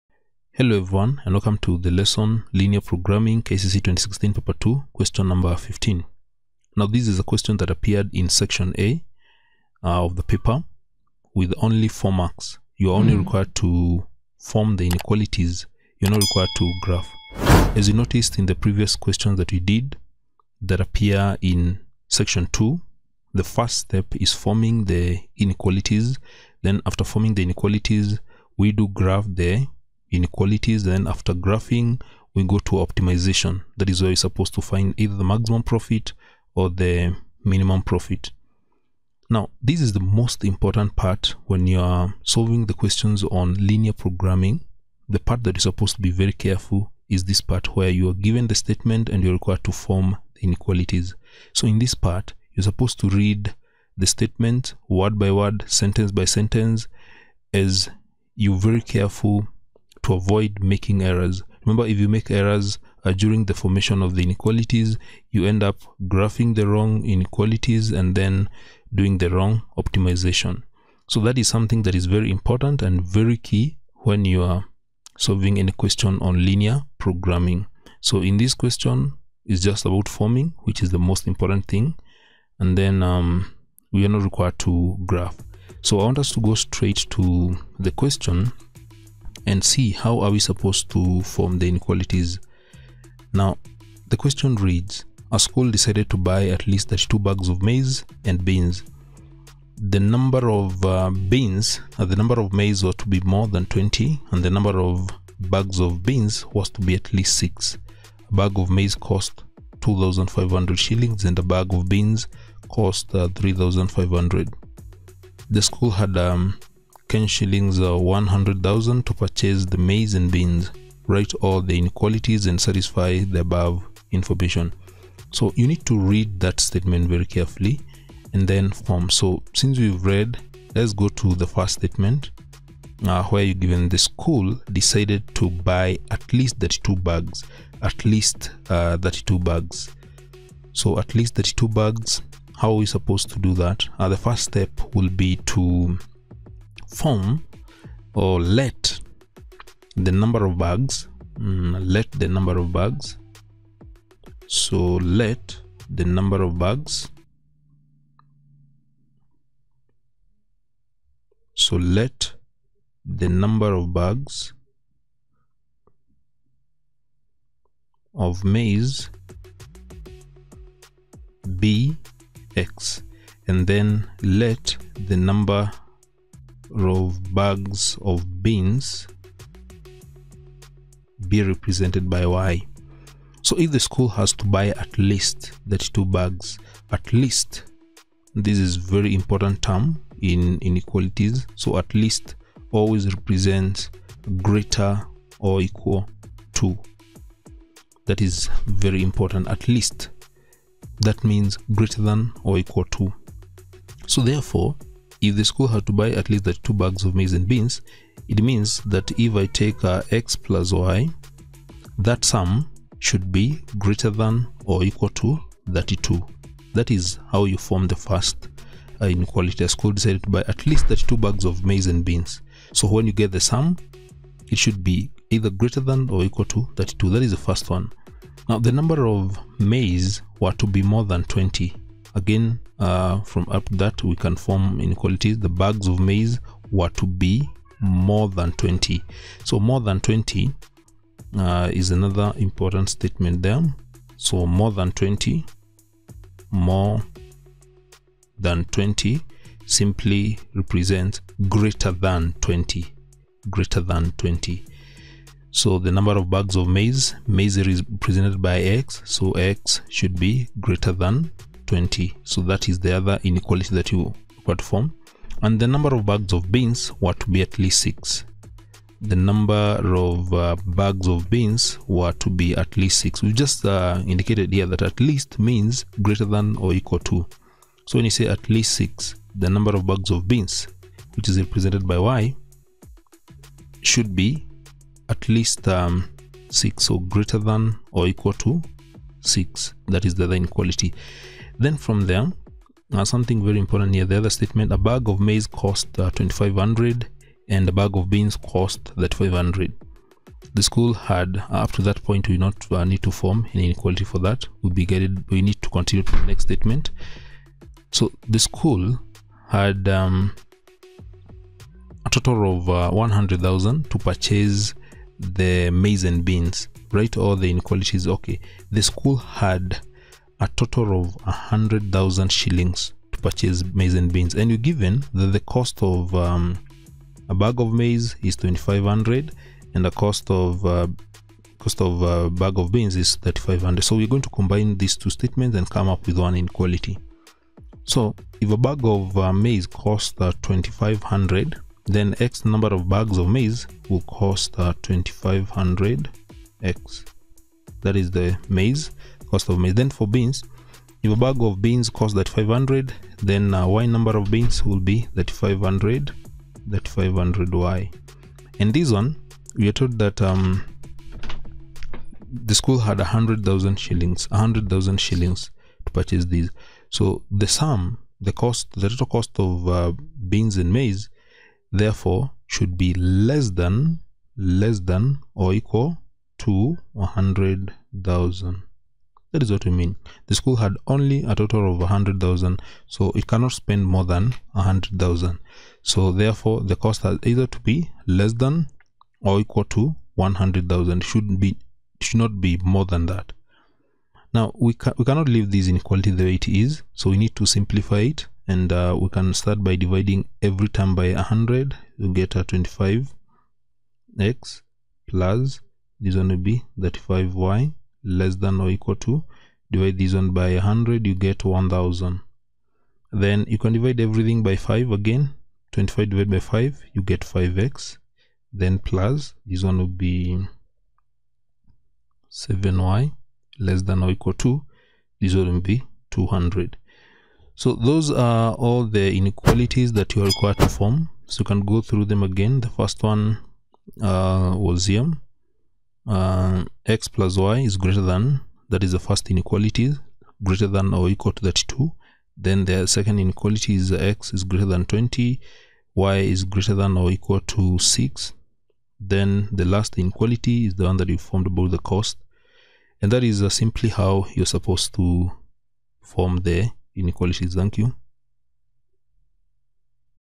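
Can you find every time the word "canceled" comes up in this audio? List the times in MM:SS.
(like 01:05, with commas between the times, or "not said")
not said.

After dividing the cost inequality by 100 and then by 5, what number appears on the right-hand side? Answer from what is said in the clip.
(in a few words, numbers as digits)
200.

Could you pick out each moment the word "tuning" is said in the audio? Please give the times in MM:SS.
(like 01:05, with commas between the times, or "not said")
not said.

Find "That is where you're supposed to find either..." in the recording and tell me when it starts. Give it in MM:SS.
00:33.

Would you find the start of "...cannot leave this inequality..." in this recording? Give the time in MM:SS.
06:35.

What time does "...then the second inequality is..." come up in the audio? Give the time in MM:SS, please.
07:22.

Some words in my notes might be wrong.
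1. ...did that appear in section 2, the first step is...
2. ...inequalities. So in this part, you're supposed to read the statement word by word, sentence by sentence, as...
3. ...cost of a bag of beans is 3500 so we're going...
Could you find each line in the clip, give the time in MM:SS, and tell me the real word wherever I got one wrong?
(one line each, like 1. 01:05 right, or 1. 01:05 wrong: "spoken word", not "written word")
1. 00:19 right
2. 00:50 right
3. 05:31 right.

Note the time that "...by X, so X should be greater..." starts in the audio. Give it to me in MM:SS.
04:18.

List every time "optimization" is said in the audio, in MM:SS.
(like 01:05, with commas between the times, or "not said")
00:32, 01:09.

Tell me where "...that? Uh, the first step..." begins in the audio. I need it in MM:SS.
02:23.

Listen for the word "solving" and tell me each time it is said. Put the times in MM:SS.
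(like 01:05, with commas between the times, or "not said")
00:42, 01:15.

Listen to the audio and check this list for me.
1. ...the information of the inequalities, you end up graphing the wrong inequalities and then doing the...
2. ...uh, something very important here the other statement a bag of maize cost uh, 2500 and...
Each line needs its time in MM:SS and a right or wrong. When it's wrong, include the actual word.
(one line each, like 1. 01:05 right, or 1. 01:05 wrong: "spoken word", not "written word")
1. 01:03 wrong: "formation", not "information"
2. 04:52 right.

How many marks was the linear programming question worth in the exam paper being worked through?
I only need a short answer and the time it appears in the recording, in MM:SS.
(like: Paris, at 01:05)
4, at 00:11.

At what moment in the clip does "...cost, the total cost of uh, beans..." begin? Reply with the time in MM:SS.
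06:08.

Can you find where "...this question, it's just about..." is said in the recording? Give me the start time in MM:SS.
01:18.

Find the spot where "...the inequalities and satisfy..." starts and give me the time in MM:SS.
02:01.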